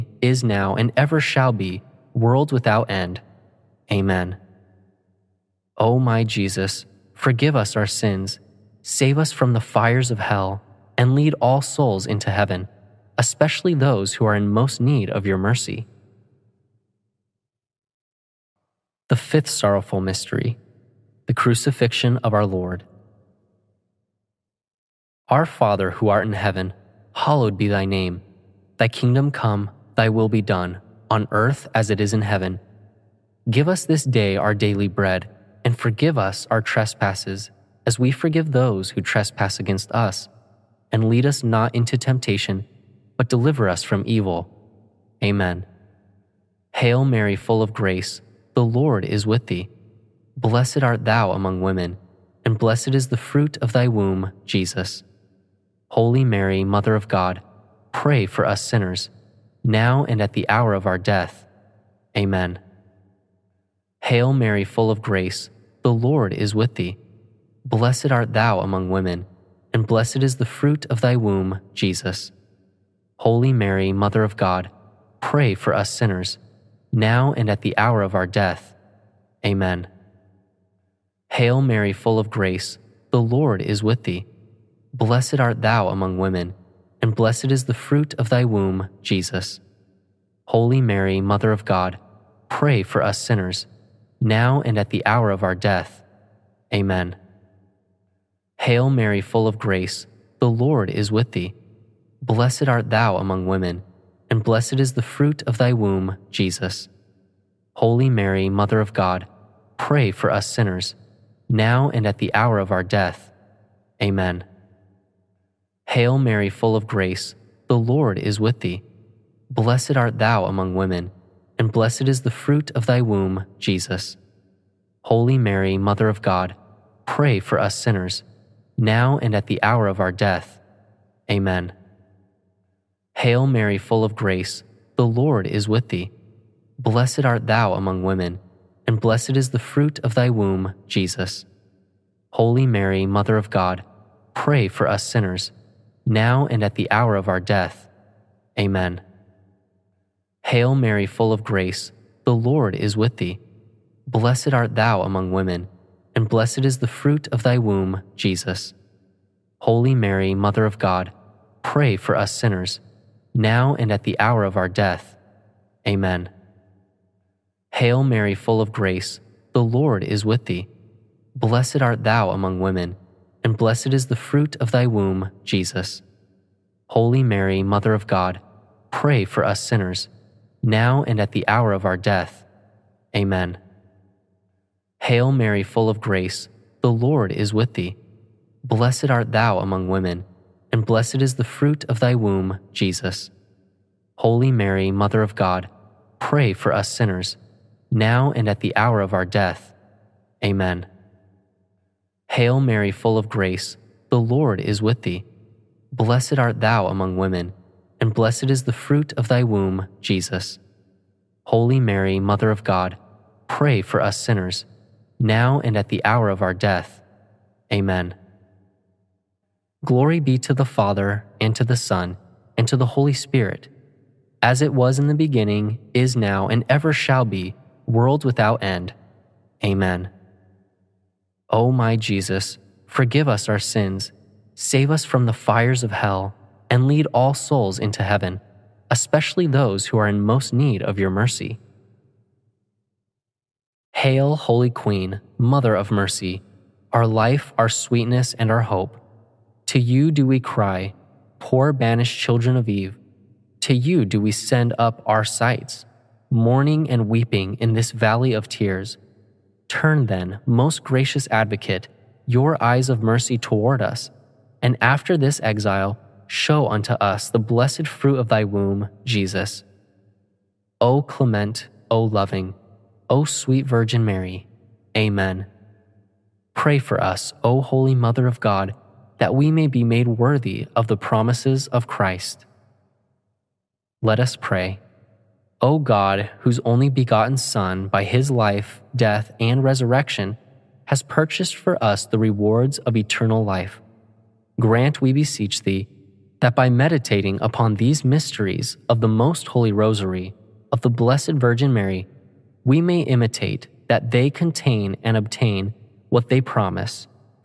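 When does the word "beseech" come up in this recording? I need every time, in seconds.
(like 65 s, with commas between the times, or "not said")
295 s.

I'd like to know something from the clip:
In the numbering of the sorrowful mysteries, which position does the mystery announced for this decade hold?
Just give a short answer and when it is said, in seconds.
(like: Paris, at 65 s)
5th, at 19 s.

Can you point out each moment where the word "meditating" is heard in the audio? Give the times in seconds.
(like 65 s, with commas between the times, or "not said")
296 s.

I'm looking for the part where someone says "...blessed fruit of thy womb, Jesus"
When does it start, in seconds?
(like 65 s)
267 s.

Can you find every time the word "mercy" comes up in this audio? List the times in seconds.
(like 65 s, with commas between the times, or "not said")
15 s, 241 s, 245 s, 263 s.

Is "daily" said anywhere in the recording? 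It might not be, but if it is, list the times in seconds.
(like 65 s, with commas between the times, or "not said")
34 s.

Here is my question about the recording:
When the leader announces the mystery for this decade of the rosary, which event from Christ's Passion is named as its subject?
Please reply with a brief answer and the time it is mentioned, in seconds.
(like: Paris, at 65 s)
The crucifixion of our Lord, at 21 s.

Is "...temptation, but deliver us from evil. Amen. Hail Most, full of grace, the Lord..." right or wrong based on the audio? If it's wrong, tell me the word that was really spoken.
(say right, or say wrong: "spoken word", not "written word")
wrong: "Mary", not "Most".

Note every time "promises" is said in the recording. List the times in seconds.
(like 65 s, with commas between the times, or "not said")
280 s, 306 s.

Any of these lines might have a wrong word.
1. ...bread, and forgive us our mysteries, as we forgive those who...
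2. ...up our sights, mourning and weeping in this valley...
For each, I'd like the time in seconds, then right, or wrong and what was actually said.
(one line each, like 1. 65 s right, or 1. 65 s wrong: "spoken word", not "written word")
1. 34 s wrong: "trespasses", not "mysteries"
2. 254 s right.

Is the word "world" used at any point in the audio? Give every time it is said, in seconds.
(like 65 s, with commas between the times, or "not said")
2 s, 227 s.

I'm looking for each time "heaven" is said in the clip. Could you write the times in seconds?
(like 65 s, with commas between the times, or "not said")
12 s, 26 s, 32 s, 238 s.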